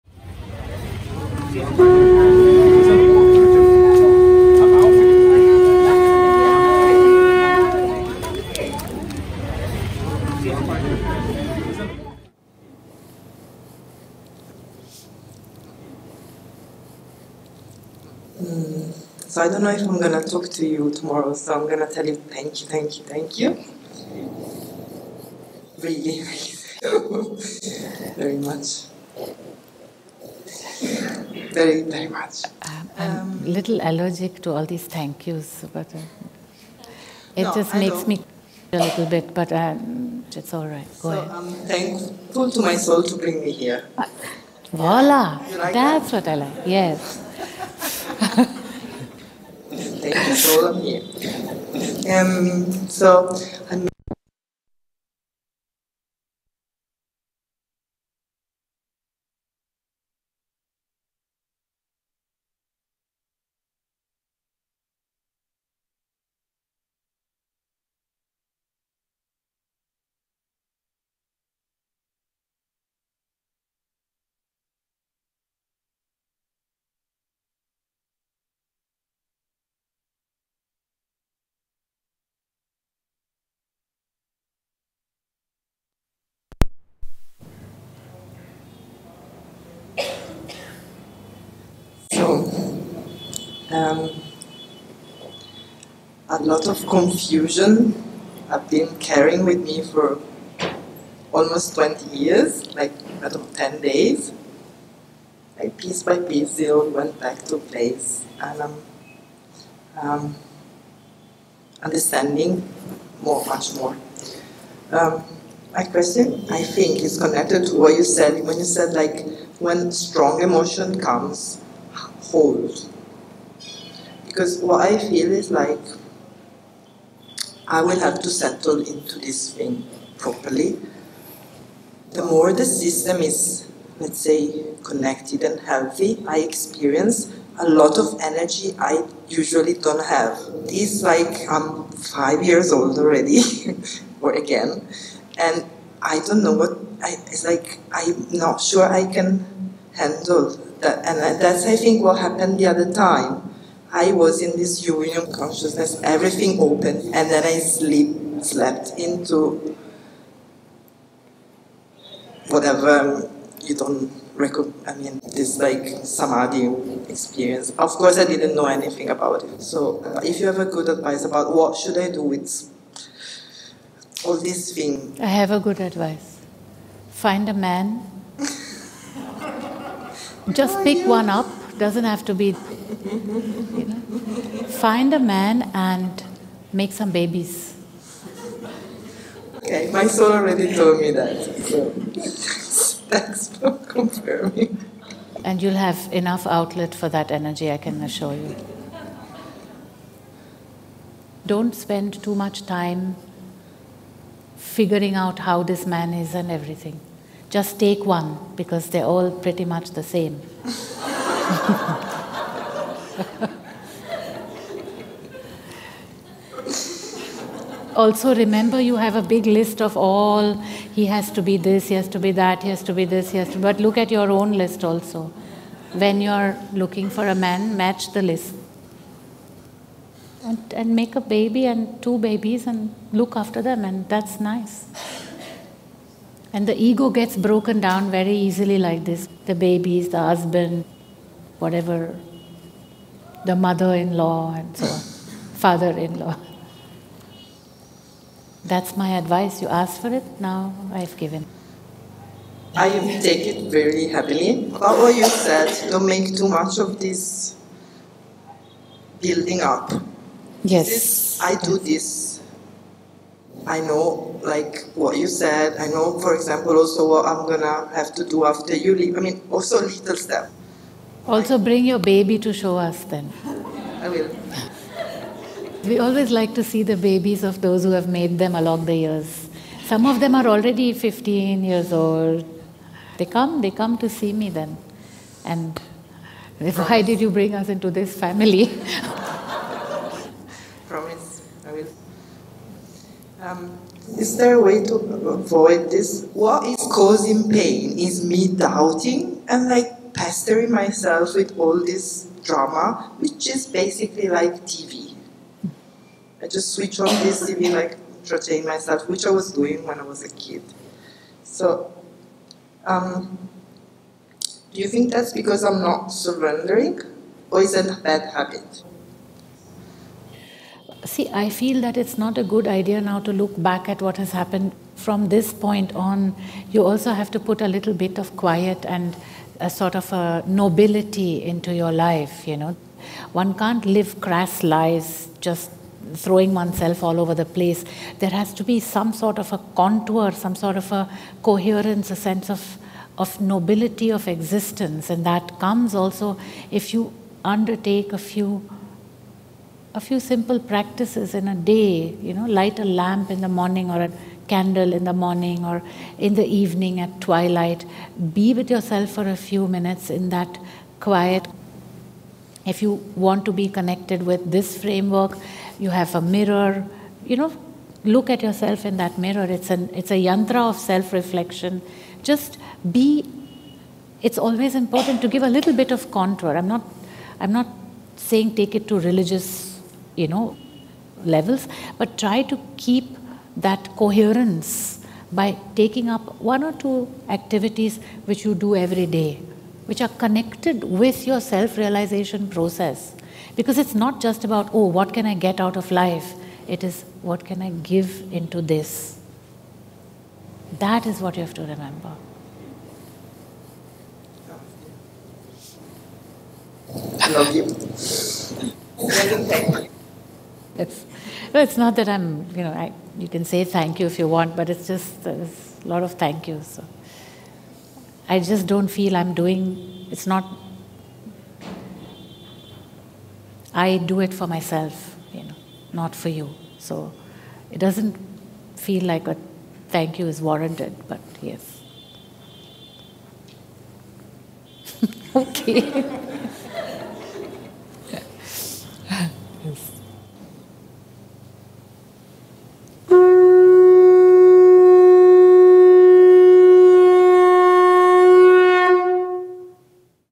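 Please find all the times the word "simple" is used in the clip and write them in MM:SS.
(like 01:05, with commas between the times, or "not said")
05:50.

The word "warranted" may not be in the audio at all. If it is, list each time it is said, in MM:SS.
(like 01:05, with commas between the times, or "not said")
07:10.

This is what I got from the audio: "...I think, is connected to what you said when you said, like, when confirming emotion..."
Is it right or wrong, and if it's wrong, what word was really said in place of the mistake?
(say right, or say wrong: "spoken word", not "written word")
wrong: "strong", not "confirming".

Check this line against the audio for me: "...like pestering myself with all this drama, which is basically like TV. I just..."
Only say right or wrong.
right.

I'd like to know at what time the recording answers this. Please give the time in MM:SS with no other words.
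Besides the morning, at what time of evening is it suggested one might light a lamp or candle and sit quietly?
05:57.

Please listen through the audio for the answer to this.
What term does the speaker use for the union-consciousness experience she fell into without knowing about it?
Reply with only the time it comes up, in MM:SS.
02:46.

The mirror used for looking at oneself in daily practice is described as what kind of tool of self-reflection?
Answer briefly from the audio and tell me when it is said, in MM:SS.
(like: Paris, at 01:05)
yantra, at 06:10.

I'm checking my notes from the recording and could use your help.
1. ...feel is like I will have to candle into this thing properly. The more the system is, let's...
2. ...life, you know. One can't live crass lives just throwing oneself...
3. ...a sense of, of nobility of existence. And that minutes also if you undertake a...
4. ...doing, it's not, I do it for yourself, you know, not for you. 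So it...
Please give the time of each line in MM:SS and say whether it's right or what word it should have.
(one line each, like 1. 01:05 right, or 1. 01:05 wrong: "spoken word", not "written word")
1. 02:04 wrong: "settle", not "candle"
2. 05:31 right
3. 05:42 wrong: "comes", not "minutes"
4. 06:59 wrong: "myself", not "yourself".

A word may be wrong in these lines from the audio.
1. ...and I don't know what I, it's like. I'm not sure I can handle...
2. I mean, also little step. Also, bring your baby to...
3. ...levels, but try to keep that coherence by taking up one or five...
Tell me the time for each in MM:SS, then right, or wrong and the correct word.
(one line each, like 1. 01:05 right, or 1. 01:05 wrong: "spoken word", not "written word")
1. 02:25 right
2. 04:29 right
3. 06:21 wrong: "two", not "five".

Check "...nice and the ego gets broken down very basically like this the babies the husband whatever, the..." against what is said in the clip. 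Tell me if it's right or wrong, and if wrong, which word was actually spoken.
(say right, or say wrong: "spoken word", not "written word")
wrong: "easily", not "basically".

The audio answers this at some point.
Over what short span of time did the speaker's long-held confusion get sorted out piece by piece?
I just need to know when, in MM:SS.
01:43.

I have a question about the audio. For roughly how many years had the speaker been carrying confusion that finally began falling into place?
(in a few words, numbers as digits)
20 years.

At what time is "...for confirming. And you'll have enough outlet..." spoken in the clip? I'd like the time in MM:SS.
03:13.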